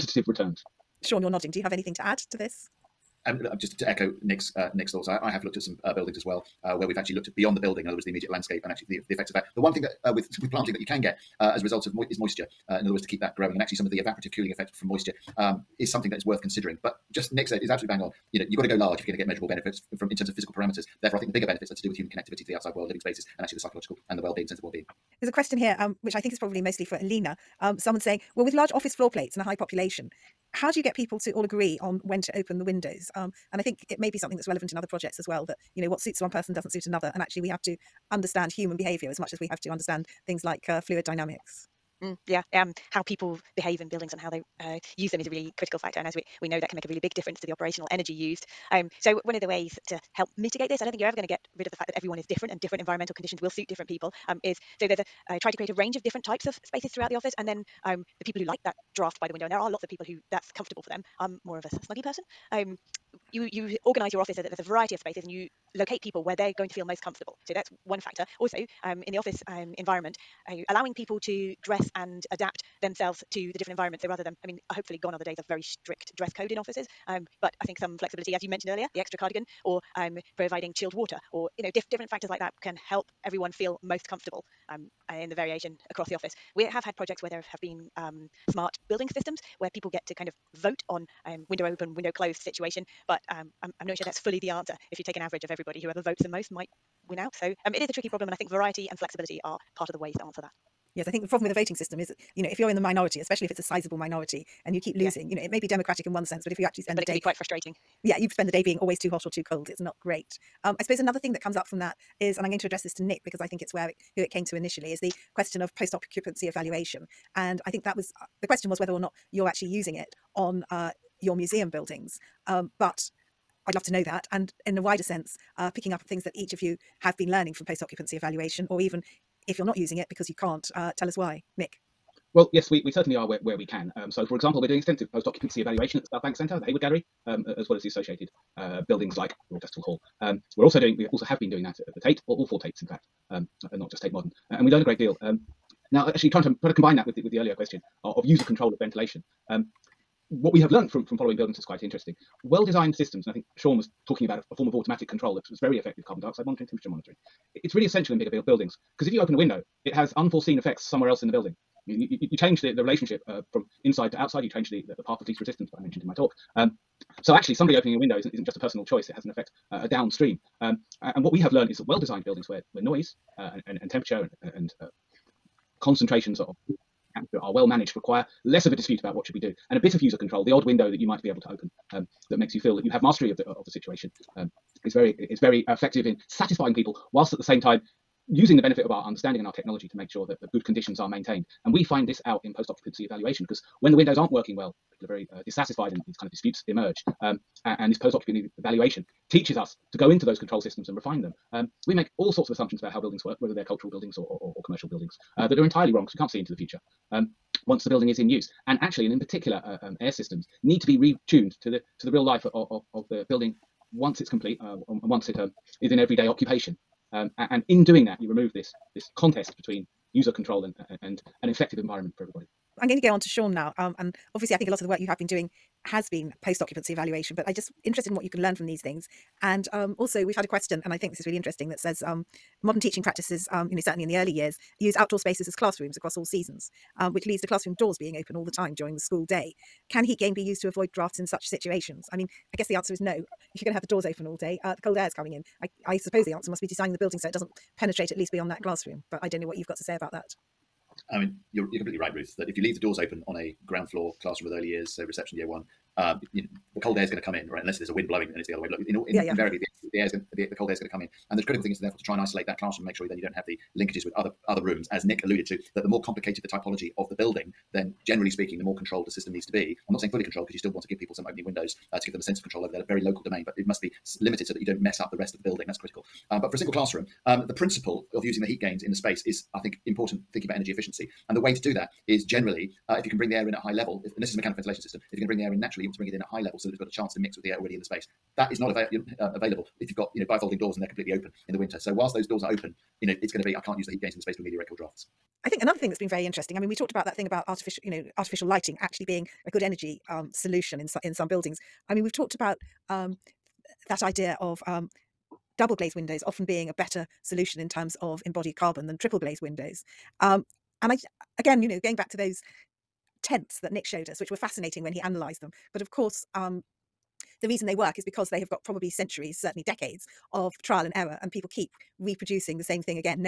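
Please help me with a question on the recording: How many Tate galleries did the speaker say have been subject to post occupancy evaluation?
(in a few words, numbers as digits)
4.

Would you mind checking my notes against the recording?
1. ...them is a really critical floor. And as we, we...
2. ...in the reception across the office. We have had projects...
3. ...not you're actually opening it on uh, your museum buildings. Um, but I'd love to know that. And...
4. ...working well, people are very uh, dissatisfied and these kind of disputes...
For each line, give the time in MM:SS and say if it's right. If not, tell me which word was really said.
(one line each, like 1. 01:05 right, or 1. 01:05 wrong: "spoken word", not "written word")
1. 00:45 wrong: "factor", not "floor"
2. 01:25 wrong: "variation", not "reception"
3. 01:58 wrong: "using", not "opening"
4. 03:14 right.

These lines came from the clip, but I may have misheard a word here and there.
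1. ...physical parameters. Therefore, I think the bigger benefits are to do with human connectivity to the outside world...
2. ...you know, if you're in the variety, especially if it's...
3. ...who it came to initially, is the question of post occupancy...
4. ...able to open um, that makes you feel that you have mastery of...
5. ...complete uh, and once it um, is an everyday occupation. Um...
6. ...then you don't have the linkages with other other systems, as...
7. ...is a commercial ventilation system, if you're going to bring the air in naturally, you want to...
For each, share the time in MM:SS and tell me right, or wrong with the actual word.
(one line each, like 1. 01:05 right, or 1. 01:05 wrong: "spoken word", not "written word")
1. 00:20 right
2. 01:42 wrong: "minority", not "variety"
3. 01:54 right
4. 03:01 right
5. 03:34 right
6. 04:23 wrong: "rooms", not "systems"
7. 04:44 wrong: "mechanical", not "commercial".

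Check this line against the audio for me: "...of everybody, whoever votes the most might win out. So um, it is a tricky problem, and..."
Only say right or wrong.
right.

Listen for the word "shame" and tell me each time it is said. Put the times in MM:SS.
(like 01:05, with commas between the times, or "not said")
not said.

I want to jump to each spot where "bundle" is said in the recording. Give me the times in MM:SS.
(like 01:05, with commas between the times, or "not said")
not said.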